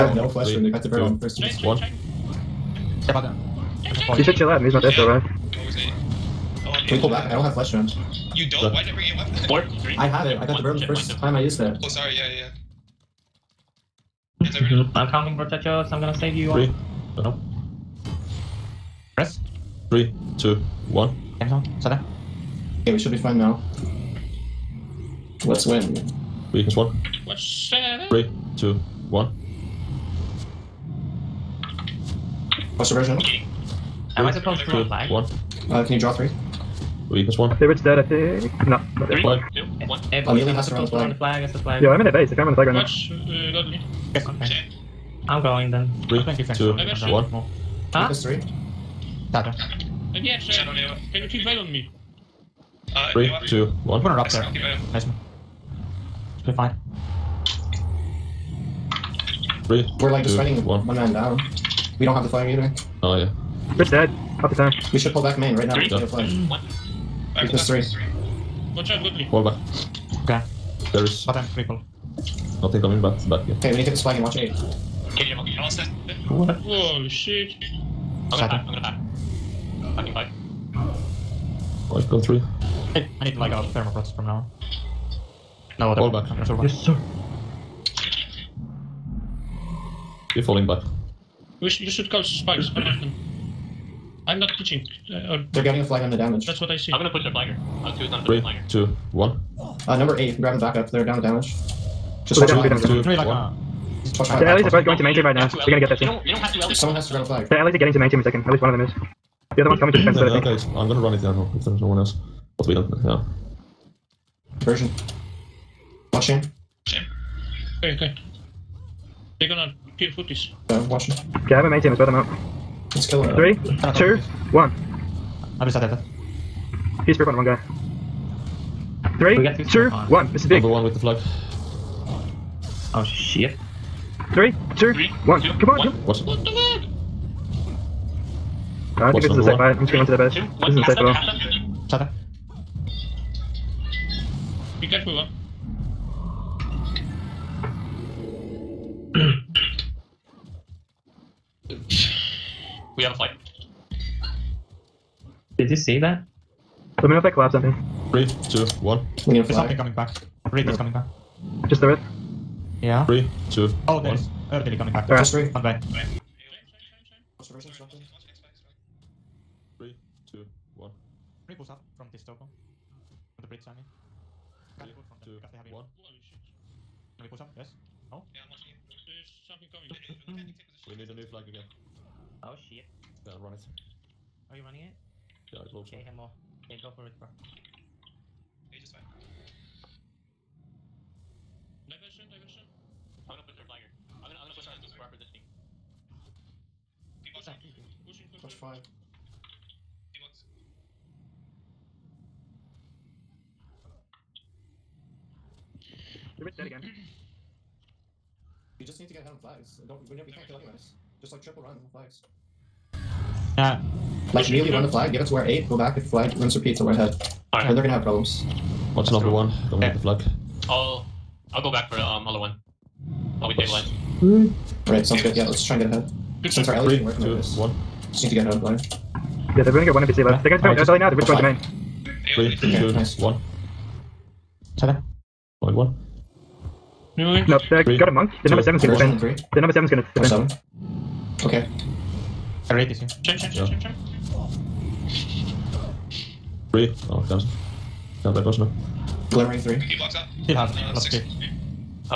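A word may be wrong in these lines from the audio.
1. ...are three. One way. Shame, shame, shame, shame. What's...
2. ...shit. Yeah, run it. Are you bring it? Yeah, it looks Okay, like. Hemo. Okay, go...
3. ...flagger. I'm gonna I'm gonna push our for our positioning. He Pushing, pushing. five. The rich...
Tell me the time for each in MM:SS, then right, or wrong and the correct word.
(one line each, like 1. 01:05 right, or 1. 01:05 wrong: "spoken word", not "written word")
1. 02:45 right
2. 03:02 wrong: "running", not "bring"
3. 03:13 right.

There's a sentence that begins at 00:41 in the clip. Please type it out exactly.
That's Yo, I'm in their base.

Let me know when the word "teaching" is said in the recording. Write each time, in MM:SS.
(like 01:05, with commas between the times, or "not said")
01:34.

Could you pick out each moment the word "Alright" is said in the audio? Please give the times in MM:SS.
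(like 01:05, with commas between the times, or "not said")
03:37, 03:44.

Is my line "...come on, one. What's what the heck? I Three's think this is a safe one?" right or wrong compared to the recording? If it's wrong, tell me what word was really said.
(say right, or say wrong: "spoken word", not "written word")
wrong: "What", not "Three".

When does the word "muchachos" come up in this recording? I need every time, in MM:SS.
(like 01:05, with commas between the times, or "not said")
00:15.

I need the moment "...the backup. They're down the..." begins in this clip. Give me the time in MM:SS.
01:40.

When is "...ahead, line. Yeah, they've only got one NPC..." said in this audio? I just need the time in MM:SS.
03:48.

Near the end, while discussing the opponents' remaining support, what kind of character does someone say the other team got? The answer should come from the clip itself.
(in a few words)
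a monk.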